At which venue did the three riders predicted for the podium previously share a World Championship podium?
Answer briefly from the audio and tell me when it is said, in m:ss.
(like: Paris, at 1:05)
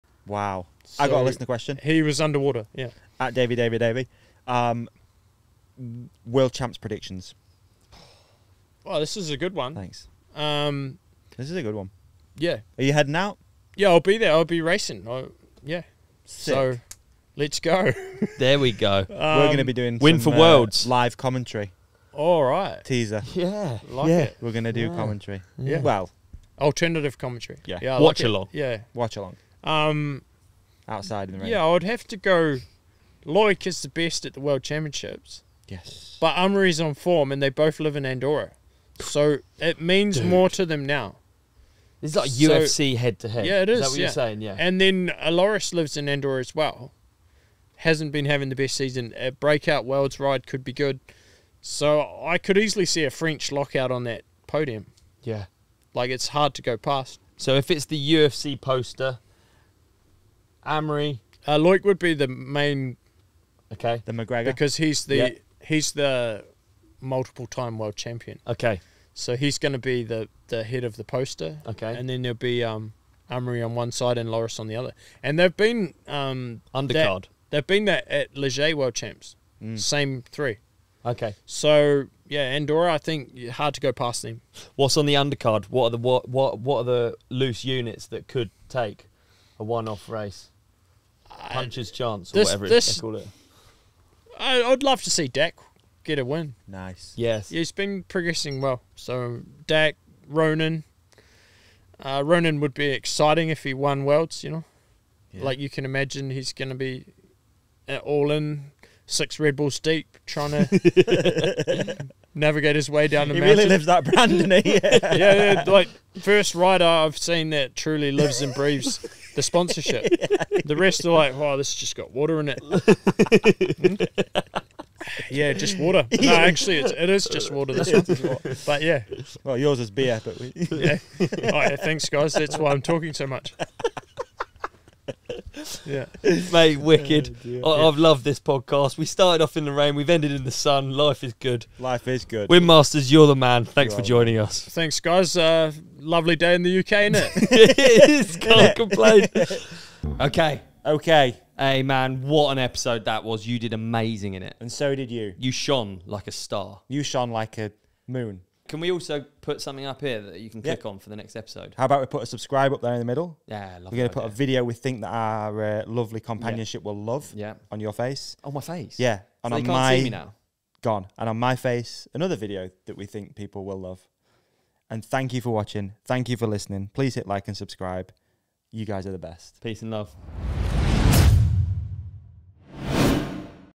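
Les Gets, at 1:18.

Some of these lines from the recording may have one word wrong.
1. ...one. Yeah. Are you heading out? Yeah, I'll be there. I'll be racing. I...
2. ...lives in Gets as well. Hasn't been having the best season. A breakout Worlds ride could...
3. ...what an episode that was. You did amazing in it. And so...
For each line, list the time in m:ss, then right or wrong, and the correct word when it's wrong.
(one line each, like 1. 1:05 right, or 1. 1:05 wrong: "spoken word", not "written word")
1. 0:11 right
2. 0:45 wrong: "Andorra", not "Gets"
3. 2:32 right.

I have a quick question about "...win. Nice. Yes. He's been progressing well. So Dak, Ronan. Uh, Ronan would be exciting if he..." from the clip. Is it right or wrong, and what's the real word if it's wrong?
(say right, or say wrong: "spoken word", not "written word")
right.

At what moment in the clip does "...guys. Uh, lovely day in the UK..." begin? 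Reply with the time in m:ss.
2:24.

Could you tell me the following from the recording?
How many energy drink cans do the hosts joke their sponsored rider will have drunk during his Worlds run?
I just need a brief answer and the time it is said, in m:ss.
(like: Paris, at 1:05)
6, at 1:49.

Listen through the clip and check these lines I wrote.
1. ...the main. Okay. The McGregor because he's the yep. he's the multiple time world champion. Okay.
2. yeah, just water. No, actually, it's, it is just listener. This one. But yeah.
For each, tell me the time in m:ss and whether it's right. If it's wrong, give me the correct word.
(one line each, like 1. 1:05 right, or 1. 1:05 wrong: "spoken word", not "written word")
1. 1:02 right
2. 2:05 wrong: "water", not "listener".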